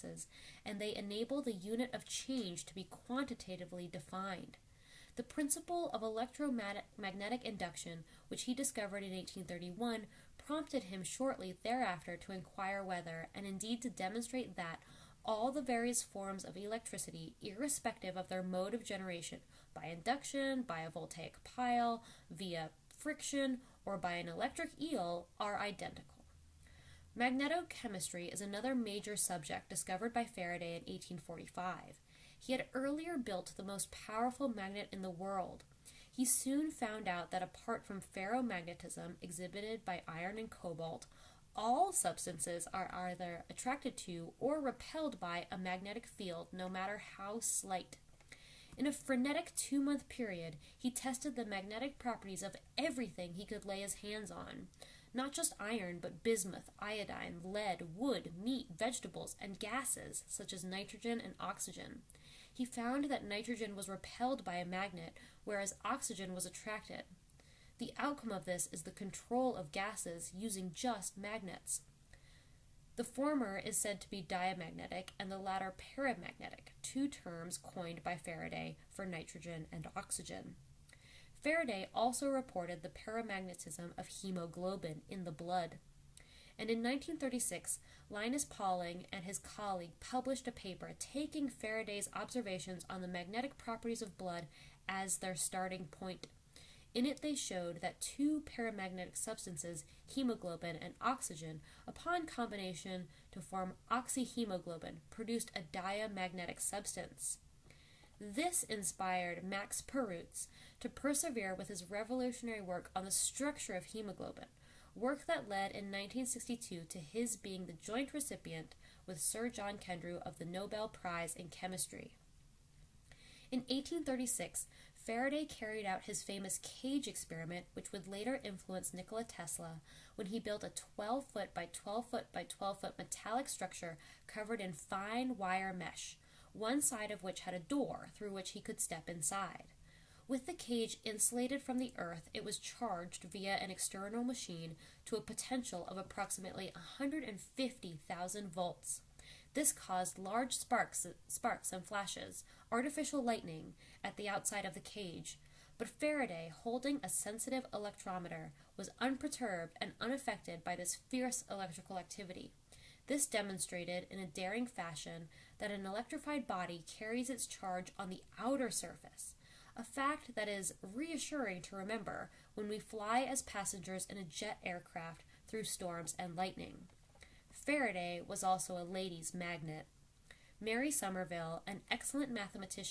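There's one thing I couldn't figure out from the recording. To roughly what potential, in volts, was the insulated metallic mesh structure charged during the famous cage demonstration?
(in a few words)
150,000 volts.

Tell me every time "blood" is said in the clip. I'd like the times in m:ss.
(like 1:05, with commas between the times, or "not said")
1:25, 1:34.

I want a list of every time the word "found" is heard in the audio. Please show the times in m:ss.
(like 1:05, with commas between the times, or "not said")
0:36, 1:02.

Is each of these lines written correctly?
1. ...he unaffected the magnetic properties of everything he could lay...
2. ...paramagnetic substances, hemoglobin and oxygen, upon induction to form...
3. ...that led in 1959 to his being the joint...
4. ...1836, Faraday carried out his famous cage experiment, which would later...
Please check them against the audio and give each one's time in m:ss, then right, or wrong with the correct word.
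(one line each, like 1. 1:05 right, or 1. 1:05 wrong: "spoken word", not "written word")
1. 0:50 wrong: "tested", not "unaffected"
2. 1:38 wrong: "combination", not "induction"
3. 1:55 wrong: "1962", not "1959"
4. 2:03 right.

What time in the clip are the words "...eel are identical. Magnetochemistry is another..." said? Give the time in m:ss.
0:24.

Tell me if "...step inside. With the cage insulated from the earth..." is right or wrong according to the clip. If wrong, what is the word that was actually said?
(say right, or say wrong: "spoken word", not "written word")
right.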